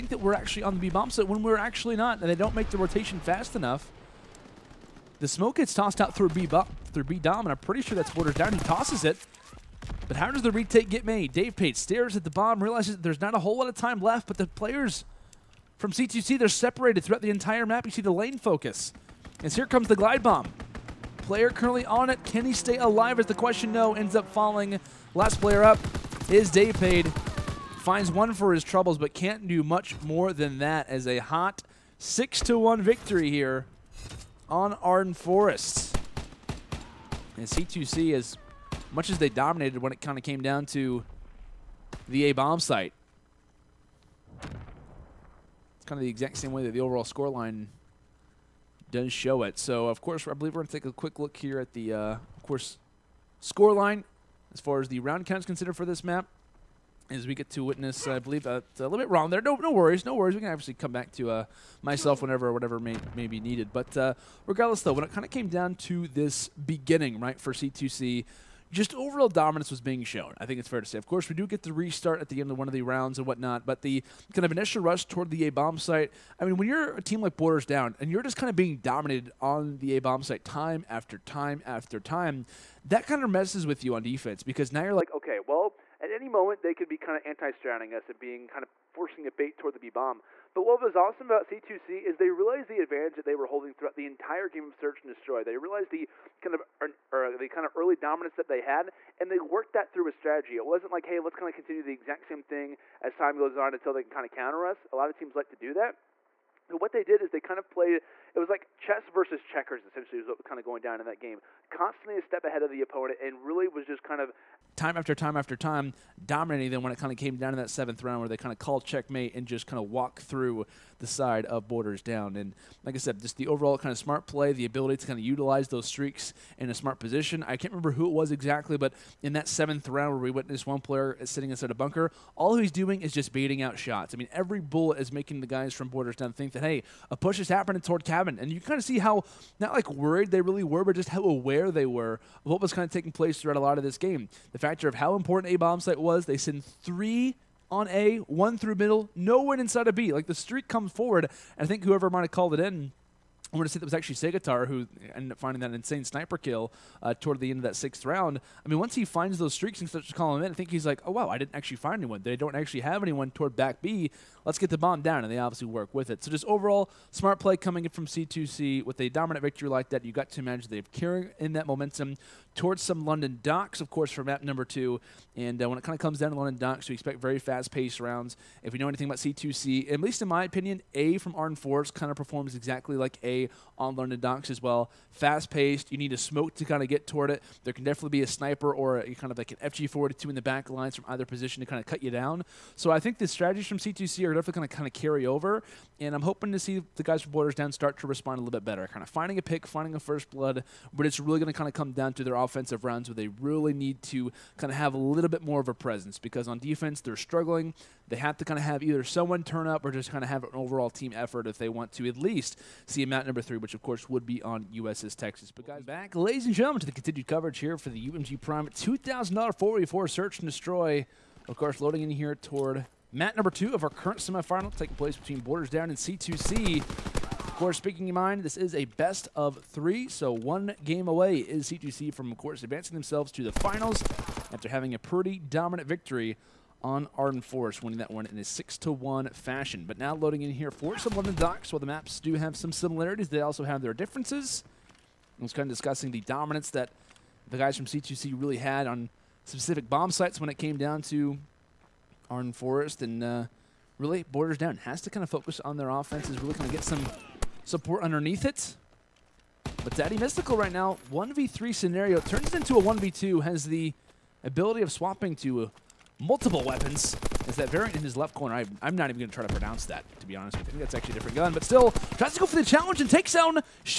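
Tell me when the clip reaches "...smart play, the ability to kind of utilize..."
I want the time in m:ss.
2:03.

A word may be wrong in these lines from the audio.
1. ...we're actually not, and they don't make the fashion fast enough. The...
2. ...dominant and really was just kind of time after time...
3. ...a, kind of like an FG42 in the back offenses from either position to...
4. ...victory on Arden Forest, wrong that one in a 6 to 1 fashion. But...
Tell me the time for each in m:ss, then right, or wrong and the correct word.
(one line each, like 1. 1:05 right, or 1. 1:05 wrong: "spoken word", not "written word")
1. 0:01 wrong: "rotation", not "fashion"
2. 1:52 wrong: "opponent", not "dominant"
3. 3:08 wrong: "lines", not "offenses"
4. 3:55 wrong: "winning", not "wrong".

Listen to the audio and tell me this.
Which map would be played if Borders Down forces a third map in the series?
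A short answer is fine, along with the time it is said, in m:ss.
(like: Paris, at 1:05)
USS Texas, at 3:34.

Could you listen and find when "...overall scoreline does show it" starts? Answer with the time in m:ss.
0:46.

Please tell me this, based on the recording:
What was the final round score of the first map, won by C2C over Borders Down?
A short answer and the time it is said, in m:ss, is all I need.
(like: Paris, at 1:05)
6-1, at 0:31.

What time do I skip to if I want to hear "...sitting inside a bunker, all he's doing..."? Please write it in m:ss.
2:11.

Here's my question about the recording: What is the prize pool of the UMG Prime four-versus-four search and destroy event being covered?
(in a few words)
$2,000.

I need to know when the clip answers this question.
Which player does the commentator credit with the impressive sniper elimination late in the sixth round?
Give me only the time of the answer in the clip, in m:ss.
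2:34.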